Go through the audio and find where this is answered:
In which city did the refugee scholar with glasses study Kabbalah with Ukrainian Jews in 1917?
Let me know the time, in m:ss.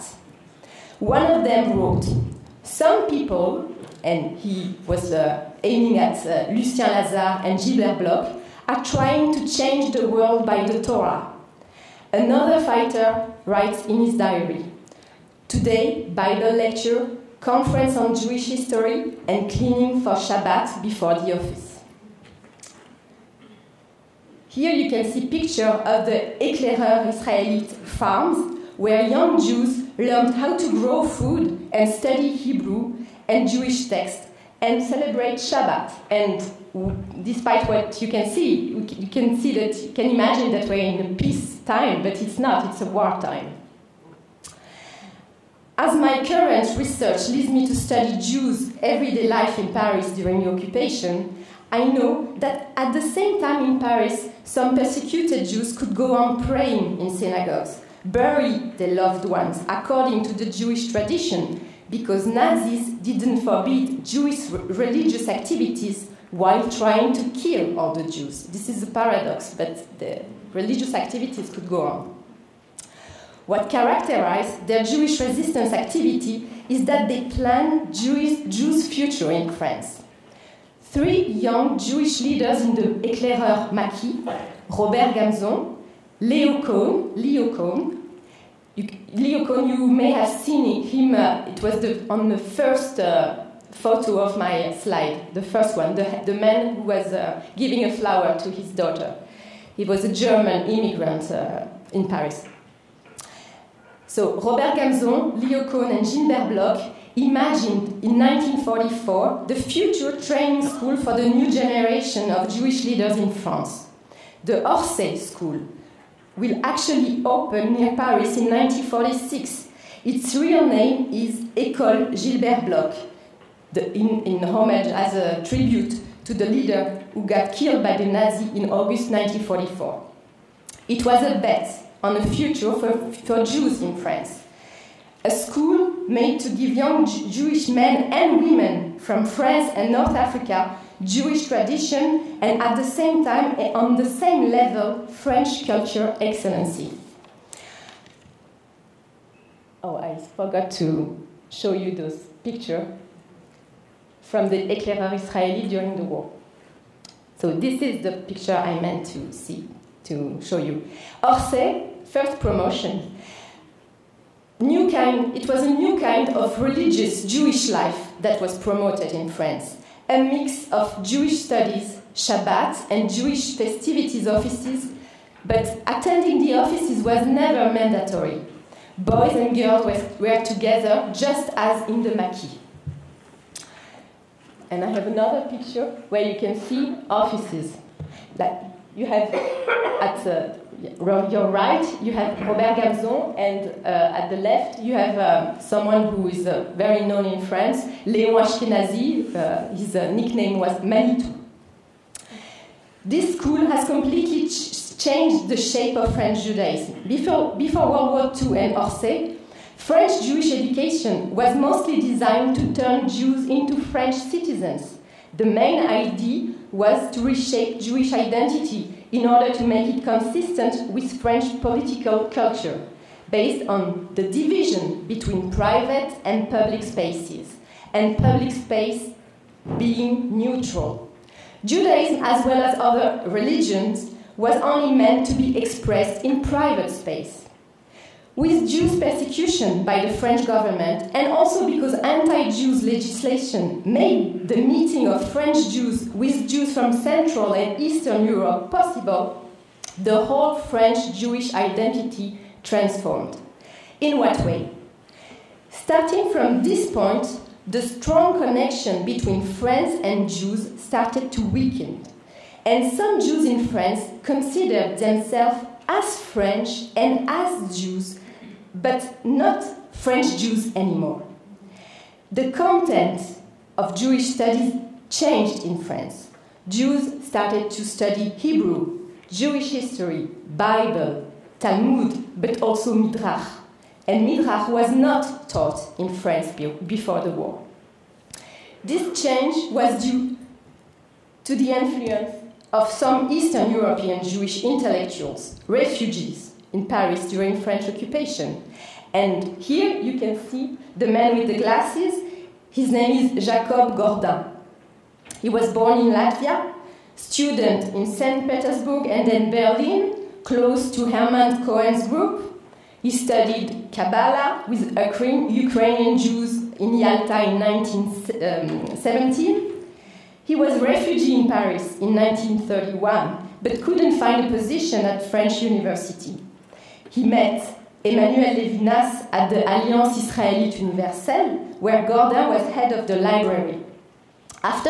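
5:16.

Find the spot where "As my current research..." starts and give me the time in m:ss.
0:45.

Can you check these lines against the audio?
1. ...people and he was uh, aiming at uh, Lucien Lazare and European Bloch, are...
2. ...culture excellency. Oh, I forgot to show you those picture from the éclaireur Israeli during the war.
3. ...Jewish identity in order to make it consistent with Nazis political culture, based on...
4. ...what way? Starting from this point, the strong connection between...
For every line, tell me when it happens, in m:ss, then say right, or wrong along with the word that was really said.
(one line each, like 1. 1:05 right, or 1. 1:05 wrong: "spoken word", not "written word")
1. 0:03 wrong: "Gilbert", not "European"
2. 2:25 right
3. 3:37 wrong: "French", not "Nazis"
4. 4:14 right.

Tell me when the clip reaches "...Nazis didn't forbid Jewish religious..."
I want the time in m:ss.
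1:02.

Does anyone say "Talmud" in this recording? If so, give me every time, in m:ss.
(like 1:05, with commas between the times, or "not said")
4:41.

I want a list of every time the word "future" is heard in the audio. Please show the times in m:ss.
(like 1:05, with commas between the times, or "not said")
1:18, 1:49, 2:12.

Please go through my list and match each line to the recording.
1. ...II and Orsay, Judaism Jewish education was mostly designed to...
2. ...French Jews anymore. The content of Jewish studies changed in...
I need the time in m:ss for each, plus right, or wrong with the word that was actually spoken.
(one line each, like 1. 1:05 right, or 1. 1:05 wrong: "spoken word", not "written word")
1. 3:28 wrong: "French", not "Judaism"
2. 4:29 right.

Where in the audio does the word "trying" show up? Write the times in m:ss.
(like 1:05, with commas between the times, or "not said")
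0:08, 1:06.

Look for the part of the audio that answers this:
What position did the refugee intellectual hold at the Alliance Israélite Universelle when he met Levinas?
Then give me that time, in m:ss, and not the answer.
5:32.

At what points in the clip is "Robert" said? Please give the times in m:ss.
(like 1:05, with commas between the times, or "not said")
1:24, 1:44, 3:12.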